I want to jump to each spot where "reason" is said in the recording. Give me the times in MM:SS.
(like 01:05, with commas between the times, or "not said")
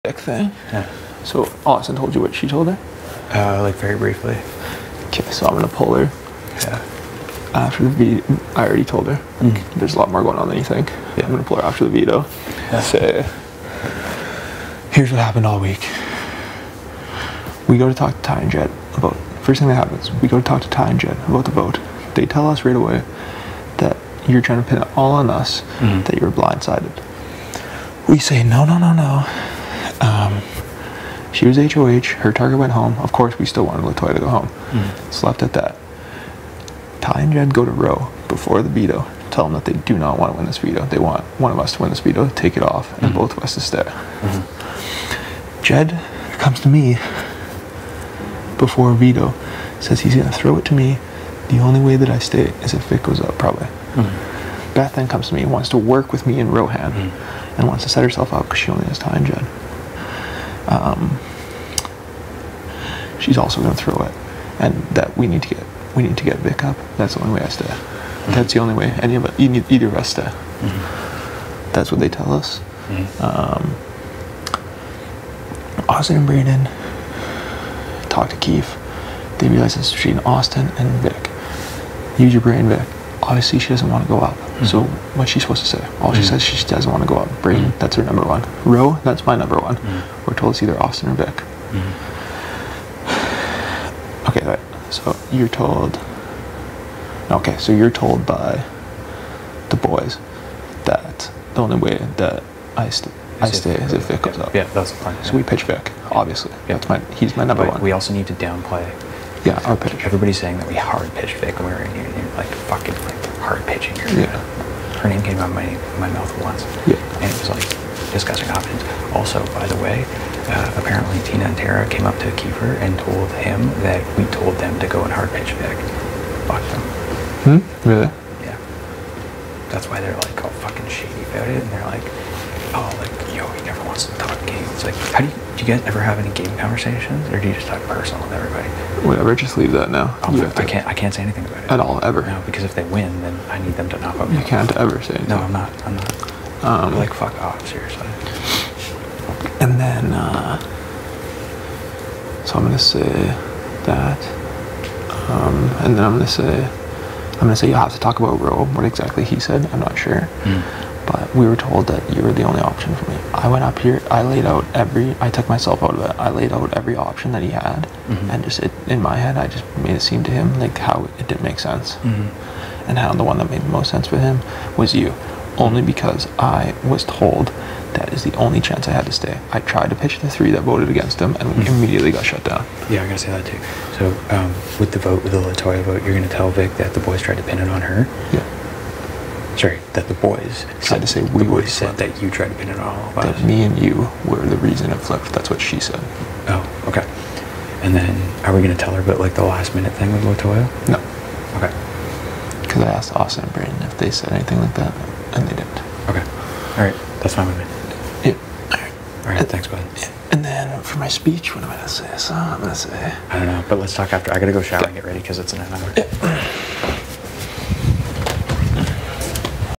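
03:14.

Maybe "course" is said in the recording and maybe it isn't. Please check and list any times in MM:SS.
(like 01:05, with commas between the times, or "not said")
00:33.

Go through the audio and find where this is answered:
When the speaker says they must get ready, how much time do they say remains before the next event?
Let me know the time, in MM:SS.
03:35.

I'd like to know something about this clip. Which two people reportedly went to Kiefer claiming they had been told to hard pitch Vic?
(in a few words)
Tina and Tara.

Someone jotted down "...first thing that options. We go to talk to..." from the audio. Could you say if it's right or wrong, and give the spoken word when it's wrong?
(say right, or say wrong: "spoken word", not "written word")
wrong: "happens", not "options".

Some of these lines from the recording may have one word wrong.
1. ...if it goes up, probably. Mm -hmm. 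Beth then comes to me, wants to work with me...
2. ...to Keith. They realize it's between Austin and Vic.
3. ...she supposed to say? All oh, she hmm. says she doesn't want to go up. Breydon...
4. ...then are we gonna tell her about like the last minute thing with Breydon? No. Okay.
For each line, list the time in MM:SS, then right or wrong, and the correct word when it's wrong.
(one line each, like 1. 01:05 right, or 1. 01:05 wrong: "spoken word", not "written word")
1. 00:52 right
2. 01:18 right
3. 01:25 right
4. 03:17 wrong: "Latoya", not "Breydon".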